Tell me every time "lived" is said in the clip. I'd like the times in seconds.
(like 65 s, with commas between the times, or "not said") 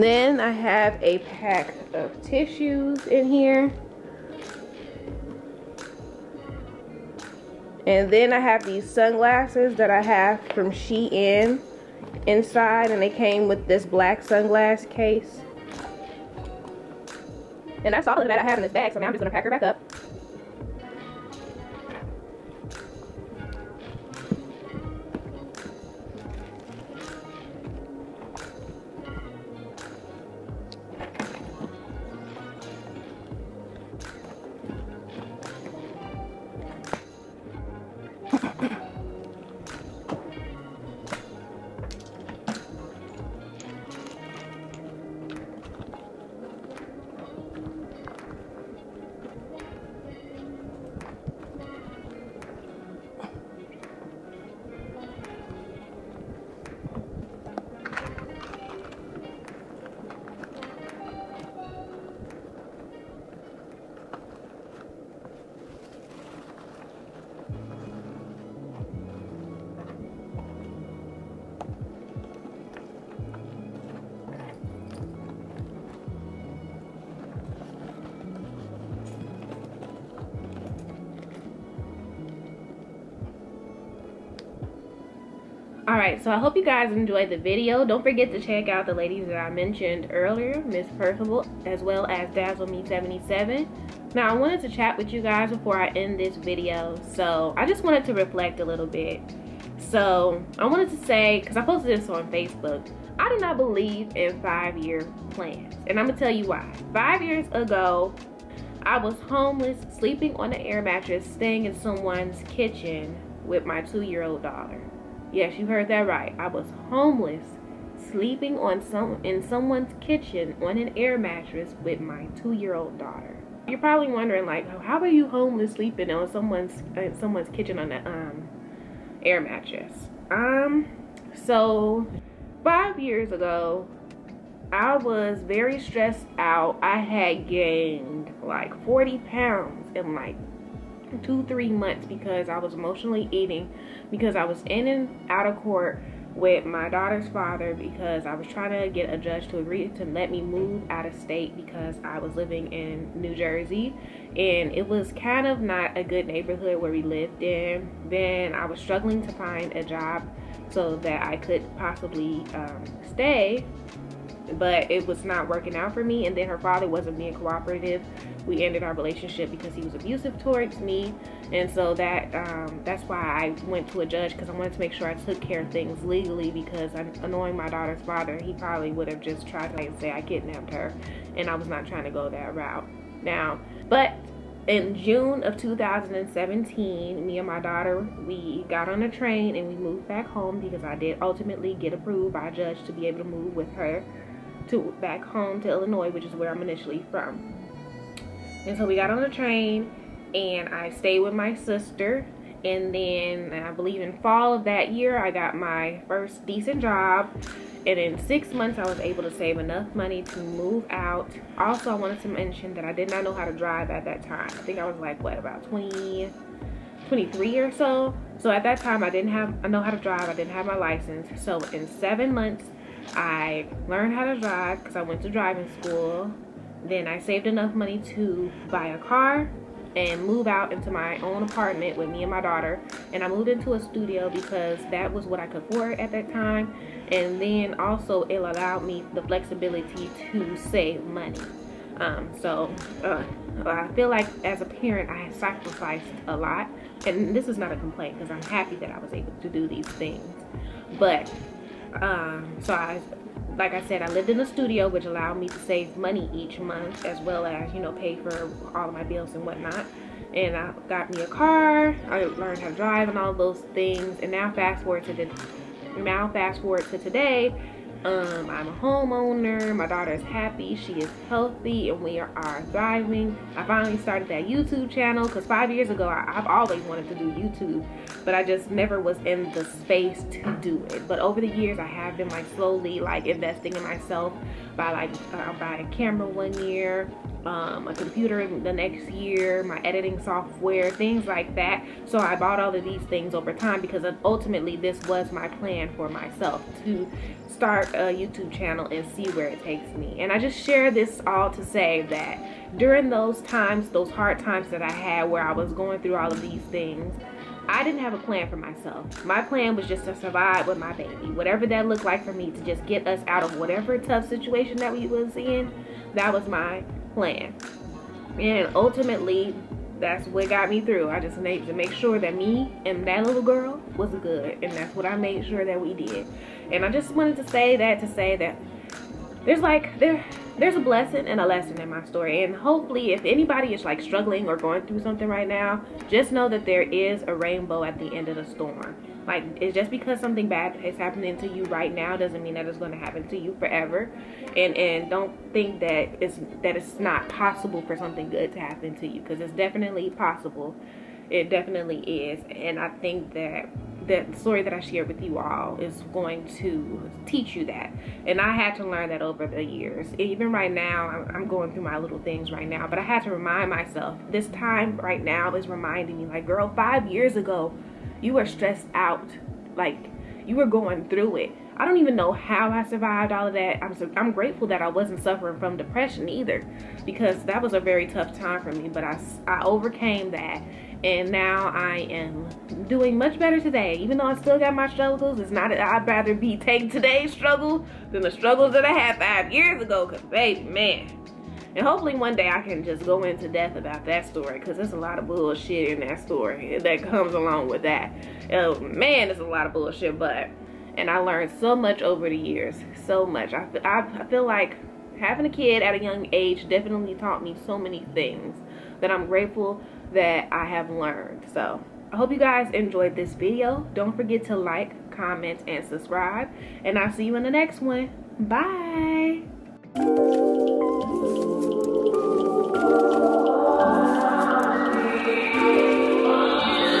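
157 s, 254 s.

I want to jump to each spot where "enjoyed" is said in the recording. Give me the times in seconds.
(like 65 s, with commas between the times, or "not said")
86 s, 412 s.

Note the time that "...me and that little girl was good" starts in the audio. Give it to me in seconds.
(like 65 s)
322 s.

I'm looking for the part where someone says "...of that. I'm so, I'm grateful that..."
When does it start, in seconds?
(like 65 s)
373 s.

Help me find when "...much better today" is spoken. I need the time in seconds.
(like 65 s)
383 s.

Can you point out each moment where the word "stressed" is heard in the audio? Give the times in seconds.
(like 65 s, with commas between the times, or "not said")
135 s, 368 s.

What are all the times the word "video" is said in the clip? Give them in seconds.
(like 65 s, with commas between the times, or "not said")
87 s, 96 s, 413 s.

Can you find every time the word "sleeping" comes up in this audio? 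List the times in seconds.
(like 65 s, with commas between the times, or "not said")
109 s, 118 s, 125 s.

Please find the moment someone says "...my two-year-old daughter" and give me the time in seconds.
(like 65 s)
113 s.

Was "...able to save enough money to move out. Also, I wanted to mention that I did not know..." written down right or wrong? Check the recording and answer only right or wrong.
right.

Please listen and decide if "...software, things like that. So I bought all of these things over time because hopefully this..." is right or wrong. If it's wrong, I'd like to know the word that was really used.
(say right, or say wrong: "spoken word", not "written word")
wrong: "ultimately", not "hopefully".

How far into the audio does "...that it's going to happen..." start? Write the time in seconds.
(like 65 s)
342 s.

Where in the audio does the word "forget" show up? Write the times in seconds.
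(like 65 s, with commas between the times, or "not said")
88 s, 414 s.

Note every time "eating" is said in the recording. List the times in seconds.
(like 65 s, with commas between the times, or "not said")
143 s.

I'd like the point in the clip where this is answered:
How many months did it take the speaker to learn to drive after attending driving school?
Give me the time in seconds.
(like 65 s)
221 s.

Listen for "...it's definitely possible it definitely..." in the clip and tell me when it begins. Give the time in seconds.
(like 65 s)
349 s.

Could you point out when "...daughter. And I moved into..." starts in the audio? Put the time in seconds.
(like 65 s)
232 s.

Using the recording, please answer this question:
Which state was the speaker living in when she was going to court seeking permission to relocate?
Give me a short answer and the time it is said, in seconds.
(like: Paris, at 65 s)
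New Jersey, at 153 s.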